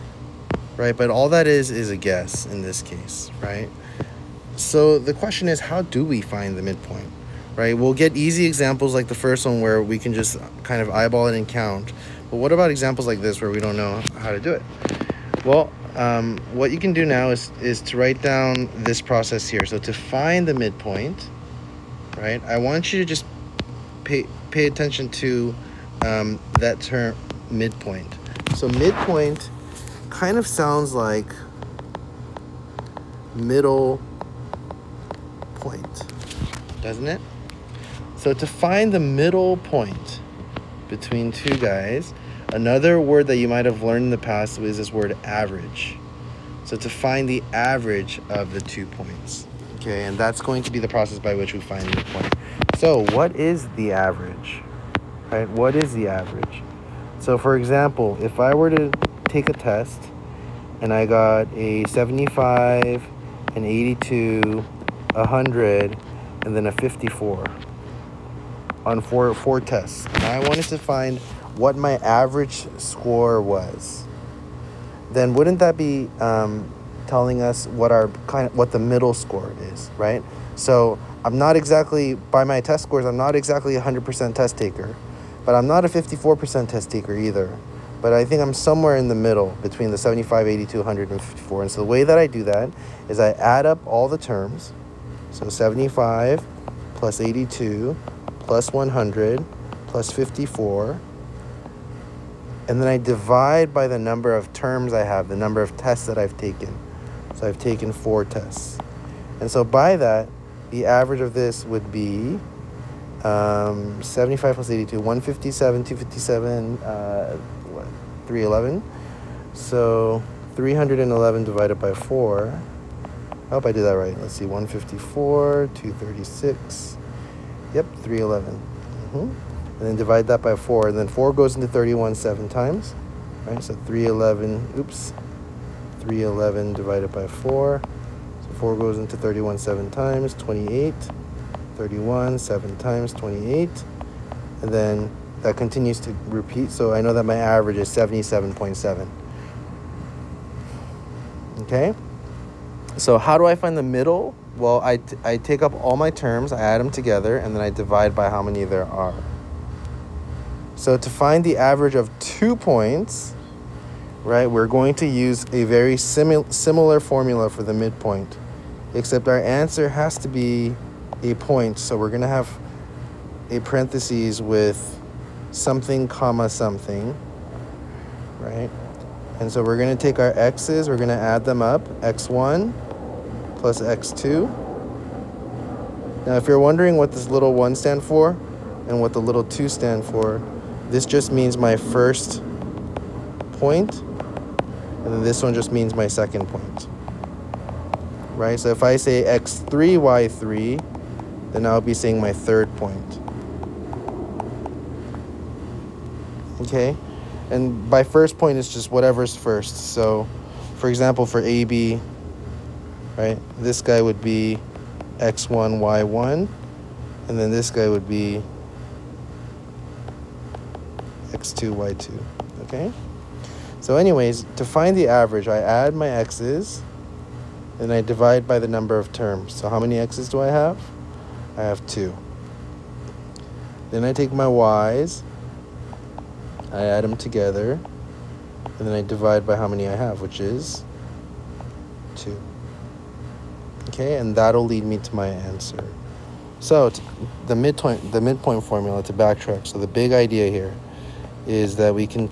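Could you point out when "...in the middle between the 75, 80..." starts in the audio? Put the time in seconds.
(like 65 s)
88 s.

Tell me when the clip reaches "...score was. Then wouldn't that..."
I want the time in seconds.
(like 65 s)
72 s.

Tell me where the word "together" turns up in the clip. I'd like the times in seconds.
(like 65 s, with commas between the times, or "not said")
156 s, 237 s.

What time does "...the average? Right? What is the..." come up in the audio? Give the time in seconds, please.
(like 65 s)
53 s.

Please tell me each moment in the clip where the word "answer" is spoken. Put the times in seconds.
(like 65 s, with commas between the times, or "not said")
169 s, 245 s.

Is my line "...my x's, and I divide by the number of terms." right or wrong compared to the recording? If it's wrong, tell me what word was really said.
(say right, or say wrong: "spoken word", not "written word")
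right.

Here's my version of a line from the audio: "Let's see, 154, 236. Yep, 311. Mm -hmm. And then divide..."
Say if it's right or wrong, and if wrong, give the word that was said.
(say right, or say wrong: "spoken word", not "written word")
right.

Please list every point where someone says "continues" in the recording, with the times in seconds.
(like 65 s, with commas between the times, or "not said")
145 s.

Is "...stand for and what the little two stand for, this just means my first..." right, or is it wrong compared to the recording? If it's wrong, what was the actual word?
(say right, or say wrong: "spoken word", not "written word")
right.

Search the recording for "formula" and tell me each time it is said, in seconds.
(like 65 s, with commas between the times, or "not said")
166 s, 248 s.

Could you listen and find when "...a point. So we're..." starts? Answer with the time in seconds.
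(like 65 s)
171 s.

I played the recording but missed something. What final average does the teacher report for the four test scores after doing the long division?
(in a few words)
77.7.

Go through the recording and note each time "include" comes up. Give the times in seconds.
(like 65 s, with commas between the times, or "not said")
not said.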